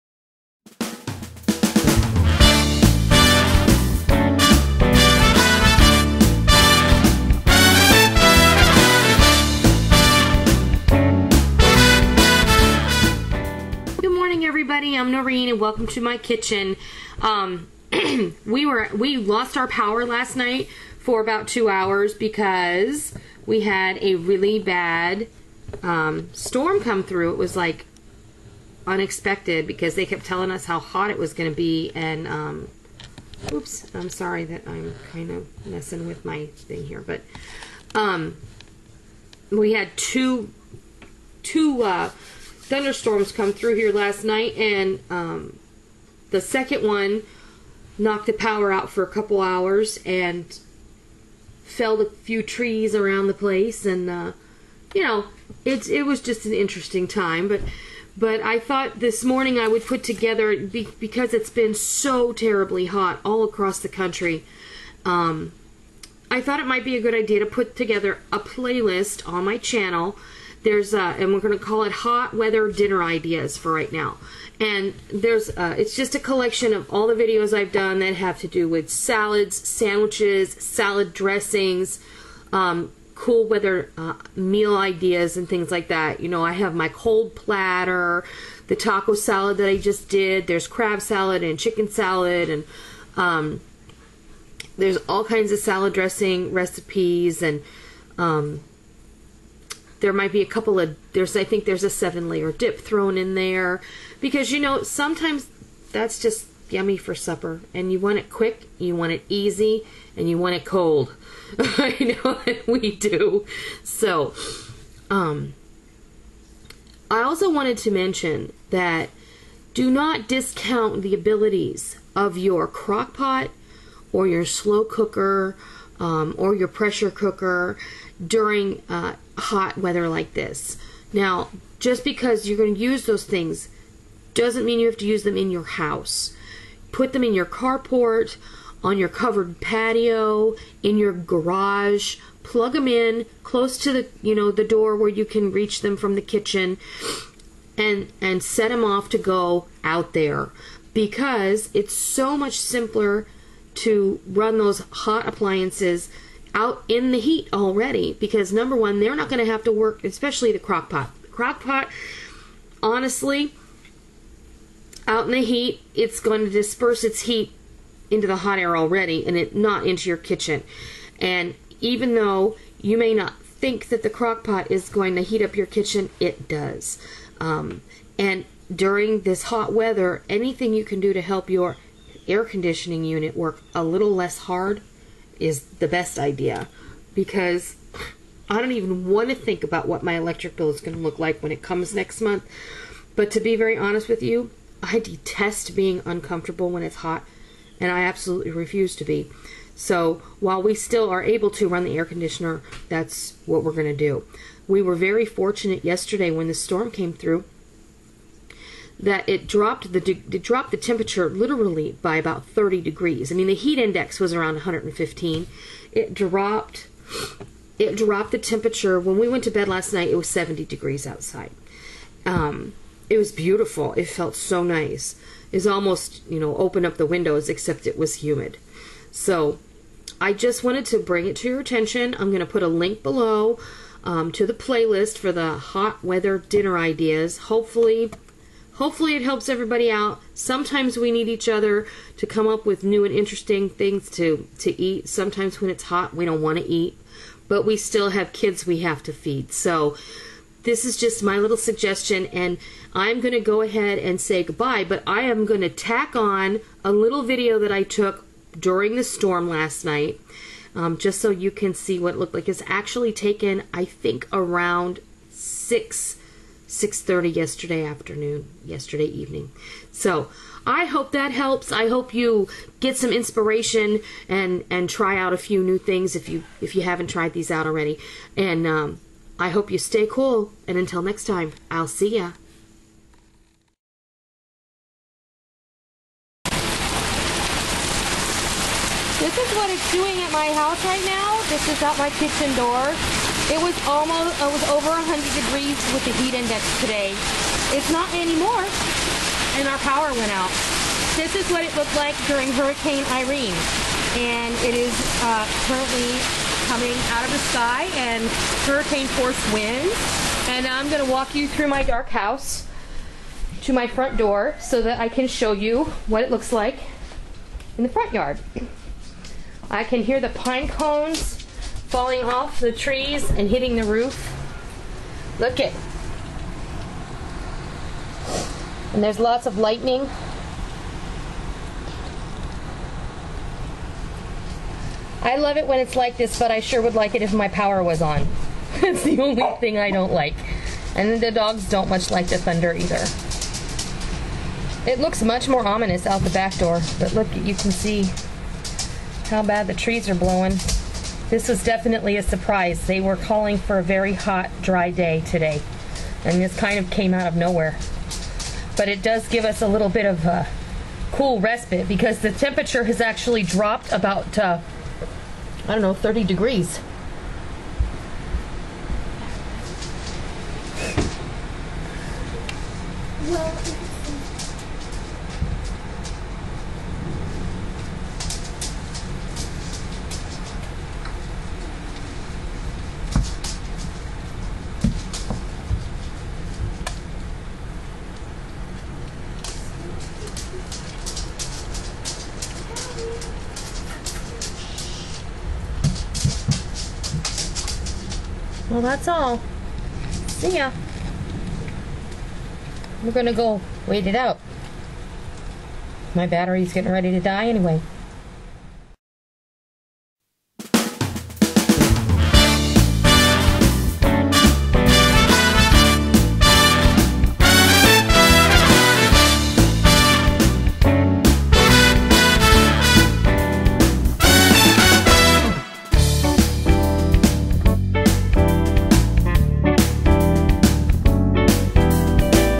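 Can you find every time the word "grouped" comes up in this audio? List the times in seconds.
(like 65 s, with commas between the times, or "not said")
not said.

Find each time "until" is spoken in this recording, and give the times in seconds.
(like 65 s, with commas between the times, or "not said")
280 s.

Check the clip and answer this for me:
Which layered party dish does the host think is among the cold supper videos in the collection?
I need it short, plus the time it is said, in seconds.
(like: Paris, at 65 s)
Seven layer dip, at 101 s.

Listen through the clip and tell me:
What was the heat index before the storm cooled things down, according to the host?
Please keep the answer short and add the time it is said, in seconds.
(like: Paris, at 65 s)
115, at 214 s.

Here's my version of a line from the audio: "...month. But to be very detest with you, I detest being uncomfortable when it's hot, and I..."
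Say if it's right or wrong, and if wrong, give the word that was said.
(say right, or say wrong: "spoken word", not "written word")
wrong: "honest", not "detest".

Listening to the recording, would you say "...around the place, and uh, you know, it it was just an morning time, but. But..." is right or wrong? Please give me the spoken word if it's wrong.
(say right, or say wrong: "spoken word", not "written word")
wrong: "interesting", not "morning".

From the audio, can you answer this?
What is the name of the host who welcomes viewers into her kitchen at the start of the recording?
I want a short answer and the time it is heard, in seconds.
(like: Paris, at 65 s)
Noreen, at 15 s.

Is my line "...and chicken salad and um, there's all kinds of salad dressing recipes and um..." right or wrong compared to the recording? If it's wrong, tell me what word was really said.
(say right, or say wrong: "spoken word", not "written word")
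right.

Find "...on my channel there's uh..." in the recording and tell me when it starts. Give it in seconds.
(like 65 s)
69 s.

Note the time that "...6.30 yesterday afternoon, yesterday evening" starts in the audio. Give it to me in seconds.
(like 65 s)
266 s.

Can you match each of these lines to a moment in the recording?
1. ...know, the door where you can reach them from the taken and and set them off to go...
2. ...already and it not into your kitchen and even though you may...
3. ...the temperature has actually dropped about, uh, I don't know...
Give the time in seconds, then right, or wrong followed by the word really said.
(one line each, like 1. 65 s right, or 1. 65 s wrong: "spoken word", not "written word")
1. 144 s wrong: "kitchen", not "taken"
2. 168 s right
3. 362 s right.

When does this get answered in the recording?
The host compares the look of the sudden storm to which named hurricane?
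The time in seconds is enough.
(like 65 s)
302 s.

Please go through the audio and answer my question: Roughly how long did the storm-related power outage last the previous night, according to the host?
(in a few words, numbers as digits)
2 hours.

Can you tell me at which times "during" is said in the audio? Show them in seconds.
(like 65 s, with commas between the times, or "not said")
128 s, 178 s, 258 s, 302 s.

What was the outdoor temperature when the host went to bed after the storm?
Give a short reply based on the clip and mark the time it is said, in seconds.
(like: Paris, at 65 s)
70 degrees, at 220 s.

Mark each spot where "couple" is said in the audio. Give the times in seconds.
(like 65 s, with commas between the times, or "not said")
49 s, 100 s.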